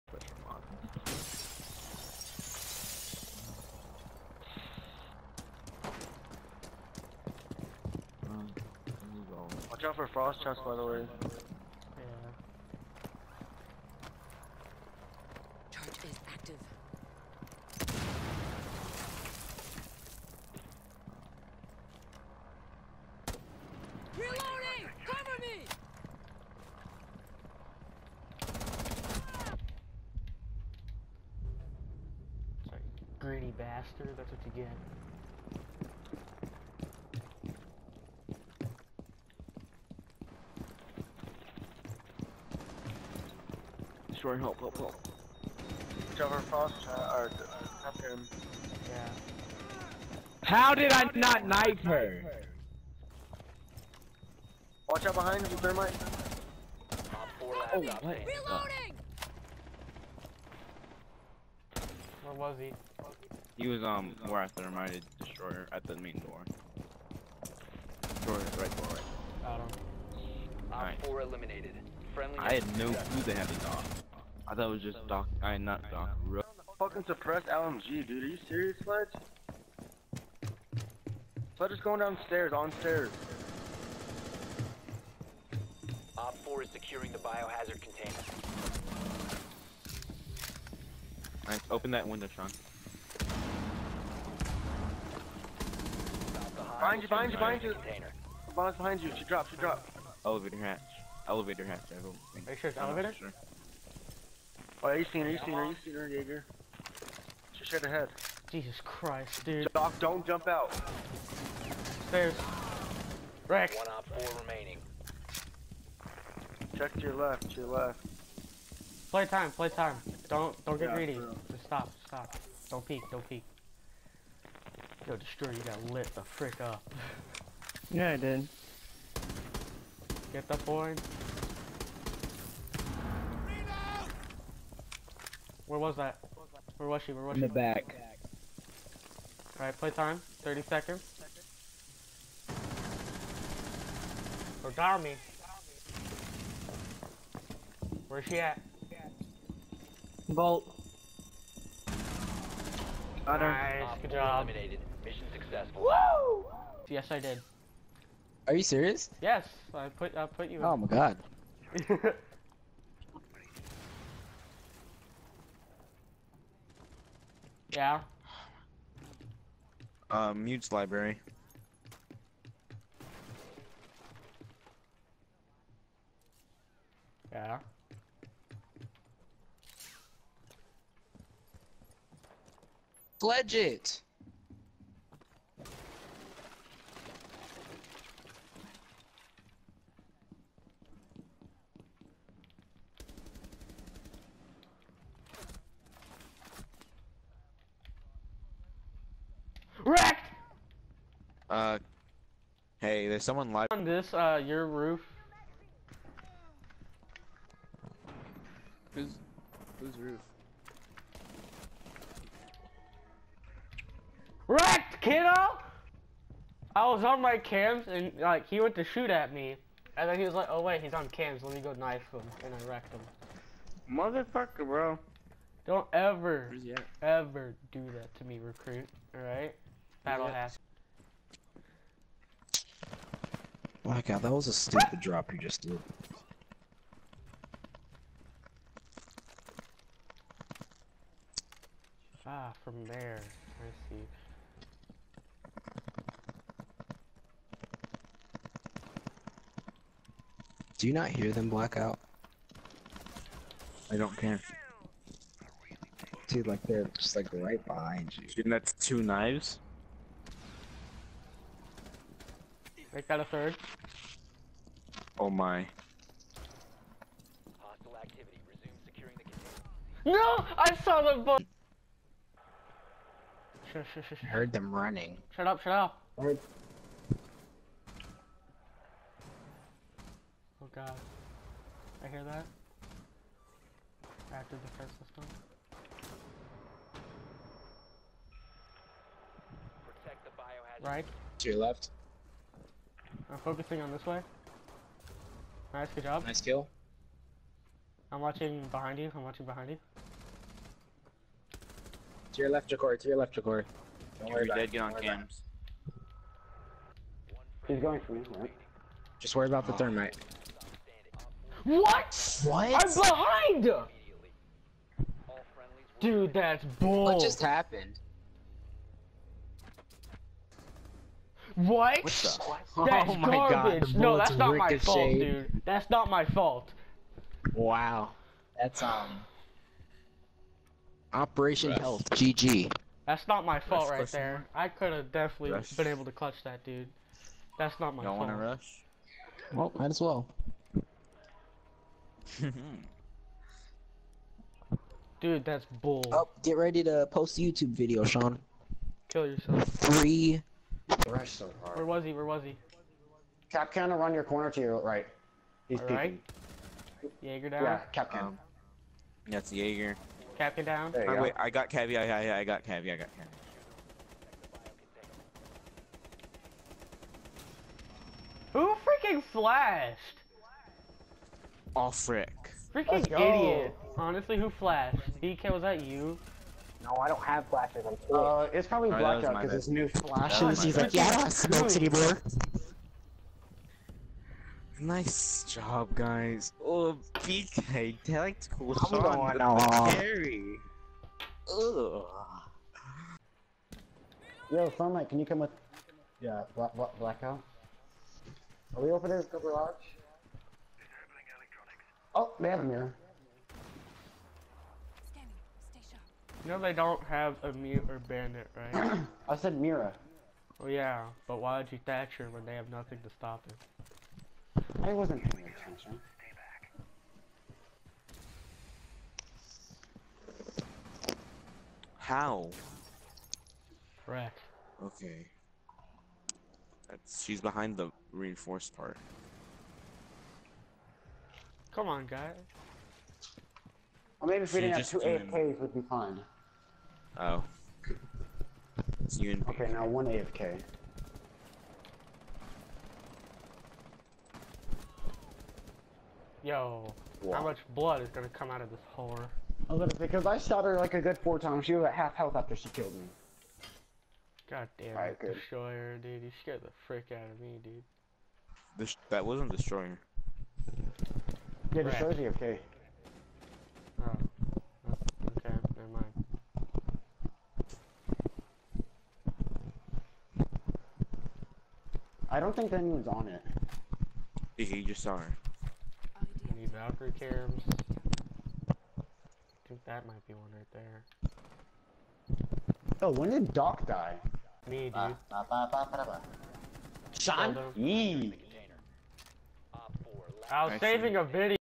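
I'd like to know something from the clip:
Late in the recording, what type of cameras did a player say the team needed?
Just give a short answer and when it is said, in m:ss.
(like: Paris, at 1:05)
Valkyrie cams, at 7:56.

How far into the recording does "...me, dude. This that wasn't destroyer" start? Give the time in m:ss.
7:37.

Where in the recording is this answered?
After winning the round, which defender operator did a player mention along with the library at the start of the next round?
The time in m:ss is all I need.
2:50.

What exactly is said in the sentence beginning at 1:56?
Check to your left, to your left.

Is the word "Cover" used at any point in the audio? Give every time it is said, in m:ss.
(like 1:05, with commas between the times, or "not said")
0:25, 0:46.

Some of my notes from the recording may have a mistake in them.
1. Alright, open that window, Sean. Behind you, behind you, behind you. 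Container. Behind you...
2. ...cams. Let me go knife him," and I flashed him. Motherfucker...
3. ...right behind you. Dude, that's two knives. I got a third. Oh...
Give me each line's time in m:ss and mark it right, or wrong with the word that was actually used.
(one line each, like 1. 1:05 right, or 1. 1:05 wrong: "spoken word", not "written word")
1. 1:31 right
2. 3:41 wrong: "wrecked", not "flashed"
3. 4:17 right.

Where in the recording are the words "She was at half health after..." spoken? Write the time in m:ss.
7:31.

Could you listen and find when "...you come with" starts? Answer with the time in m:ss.
6:35.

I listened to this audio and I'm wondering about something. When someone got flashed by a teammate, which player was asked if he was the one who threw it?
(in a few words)
DK.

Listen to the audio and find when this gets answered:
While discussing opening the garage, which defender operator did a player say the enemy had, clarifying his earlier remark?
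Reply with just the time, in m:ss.
6:49.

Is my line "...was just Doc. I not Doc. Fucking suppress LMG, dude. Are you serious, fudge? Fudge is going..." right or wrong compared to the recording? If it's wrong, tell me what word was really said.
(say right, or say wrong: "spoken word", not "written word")
right.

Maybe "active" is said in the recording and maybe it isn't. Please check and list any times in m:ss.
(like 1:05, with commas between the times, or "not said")
0:16, 4:44.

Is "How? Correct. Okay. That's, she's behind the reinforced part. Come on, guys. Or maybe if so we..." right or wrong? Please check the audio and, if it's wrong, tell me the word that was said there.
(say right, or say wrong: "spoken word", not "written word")
right.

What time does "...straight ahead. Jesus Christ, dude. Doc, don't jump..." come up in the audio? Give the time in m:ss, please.
1:47.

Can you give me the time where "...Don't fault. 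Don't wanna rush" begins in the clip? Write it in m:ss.
5:38.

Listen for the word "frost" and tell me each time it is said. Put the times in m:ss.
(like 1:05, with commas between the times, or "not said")
0:10, 0:46.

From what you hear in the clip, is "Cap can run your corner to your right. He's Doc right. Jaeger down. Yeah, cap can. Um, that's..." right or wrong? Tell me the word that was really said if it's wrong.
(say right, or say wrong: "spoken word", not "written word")
wrong: "All", not "Doc".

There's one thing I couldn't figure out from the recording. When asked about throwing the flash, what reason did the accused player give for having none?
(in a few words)
I'm poor.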